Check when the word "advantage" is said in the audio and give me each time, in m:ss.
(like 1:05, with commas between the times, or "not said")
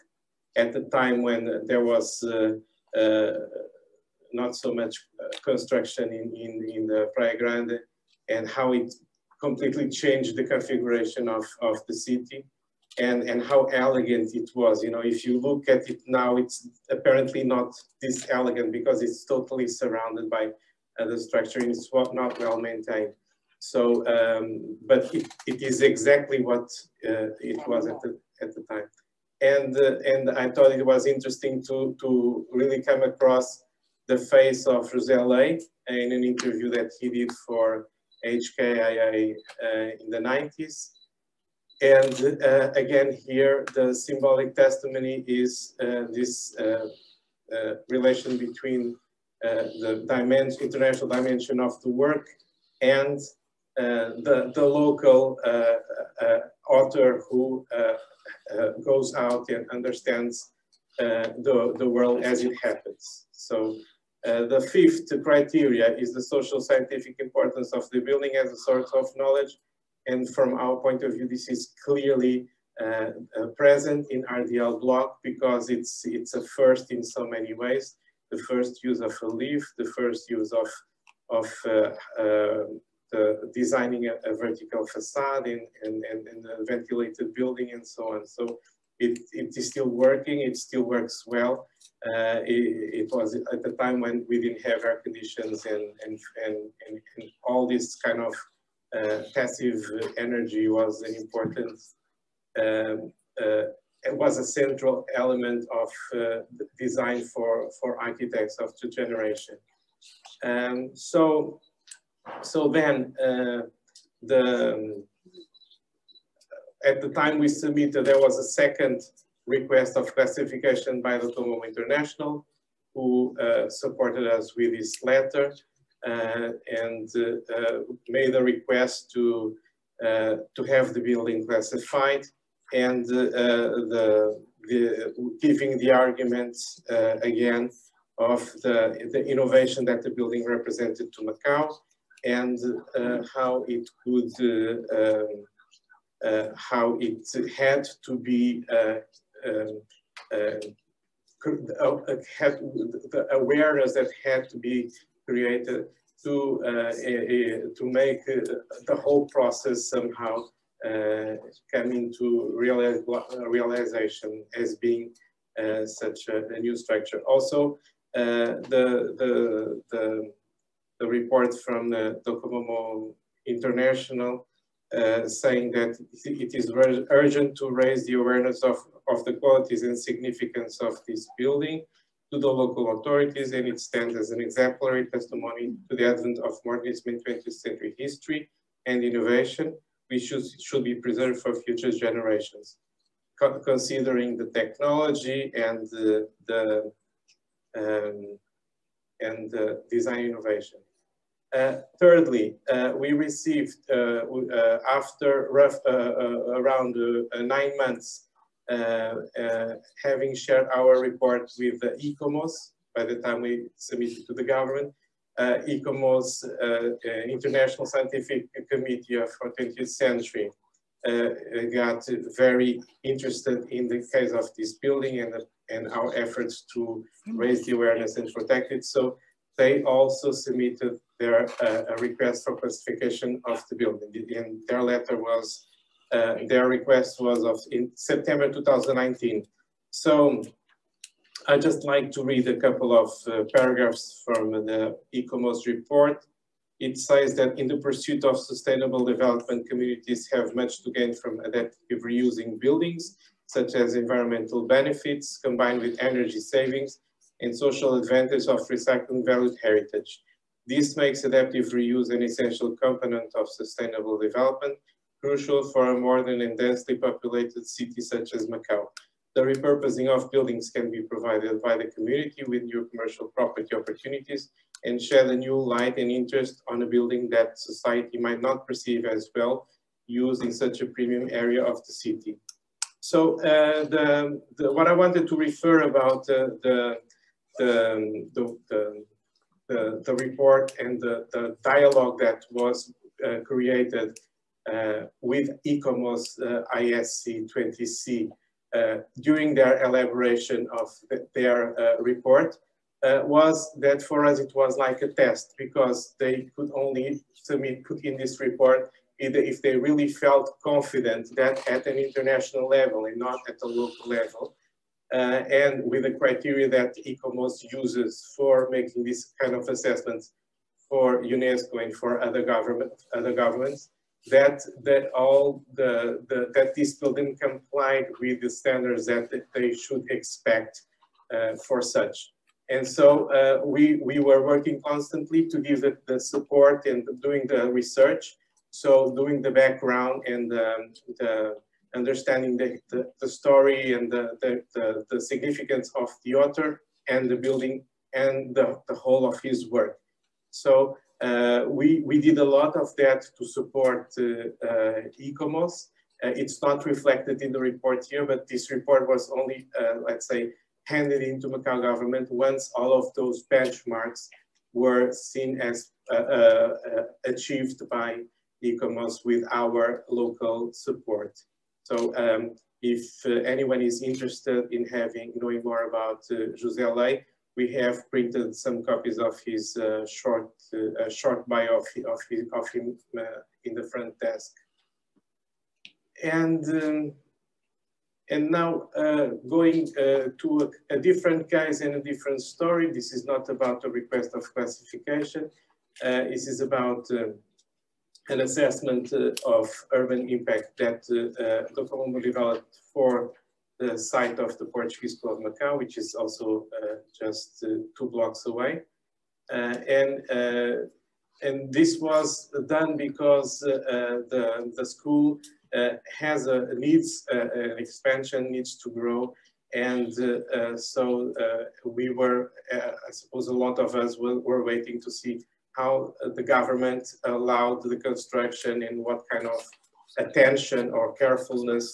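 4:18.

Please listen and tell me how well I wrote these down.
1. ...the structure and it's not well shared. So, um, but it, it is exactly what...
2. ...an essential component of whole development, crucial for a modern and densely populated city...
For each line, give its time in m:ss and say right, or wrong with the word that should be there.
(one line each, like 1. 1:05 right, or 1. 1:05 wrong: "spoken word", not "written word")
1. 0:21 wrong: "maintained", not "shared"
2. 4:22 wrong: "sustainable", not "whole".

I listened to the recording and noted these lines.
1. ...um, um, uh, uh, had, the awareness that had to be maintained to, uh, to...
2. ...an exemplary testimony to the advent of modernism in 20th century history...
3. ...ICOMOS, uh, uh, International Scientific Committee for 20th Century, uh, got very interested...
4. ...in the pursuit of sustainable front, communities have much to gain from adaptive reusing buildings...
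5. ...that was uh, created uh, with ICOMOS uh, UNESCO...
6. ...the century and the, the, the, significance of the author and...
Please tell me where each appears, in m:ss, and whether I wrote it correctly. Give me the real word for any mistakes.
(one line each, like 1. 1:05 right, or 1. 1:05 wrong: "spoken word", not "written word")
1. 2:29 wrong: "created", not "maintained"
2. 3:04 right
3. 3:35 right
4. 4:07 wrong: "development", not "front"
5. 4:52 wrong: "ISC", not "UNESCO"
6. 5:43 wrong: "story", not "century".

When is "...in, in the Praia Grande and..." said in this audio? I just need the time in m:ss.
0:06.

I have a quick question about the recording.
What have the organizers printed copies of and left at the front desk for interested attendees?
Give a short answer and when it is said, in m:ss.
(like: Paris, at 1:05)
Short bio, at 6:21.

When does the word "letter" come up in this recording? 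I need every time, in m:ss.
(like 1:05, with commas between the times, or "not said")
2:05, 3:54.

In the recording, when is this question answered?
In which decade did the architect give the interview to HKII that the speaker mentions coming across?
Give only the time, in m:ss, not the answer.
0:40.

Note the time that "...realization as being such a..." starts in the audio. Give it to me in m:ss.
2:43.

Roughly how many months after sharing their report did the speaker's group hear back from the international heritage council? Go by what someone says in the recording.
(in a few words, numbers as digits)
9.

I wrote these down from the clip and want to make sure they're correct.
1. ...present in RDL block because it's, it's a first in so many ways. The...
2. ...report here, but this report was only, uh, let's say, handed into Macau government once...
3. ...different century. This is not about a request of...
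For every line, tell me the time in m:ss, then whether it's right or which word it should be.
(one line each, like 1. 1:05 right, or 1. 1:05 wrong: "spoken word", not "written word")
1. 1:13 right
2. 5:57 right
3. 6:32 wrong: "story", not "century".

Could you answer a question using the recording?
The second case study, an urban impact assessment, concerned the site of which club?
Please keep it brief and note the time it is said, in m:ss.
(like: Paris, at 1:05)
Portuguese Club Macau, at 6:44.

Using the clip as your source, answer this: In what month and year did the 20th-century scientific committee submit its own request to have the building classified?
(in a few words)
September 2019.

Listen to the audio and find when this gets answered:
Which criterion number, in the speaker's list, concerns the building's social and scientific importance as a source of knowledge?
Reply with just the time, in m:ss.
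1:04.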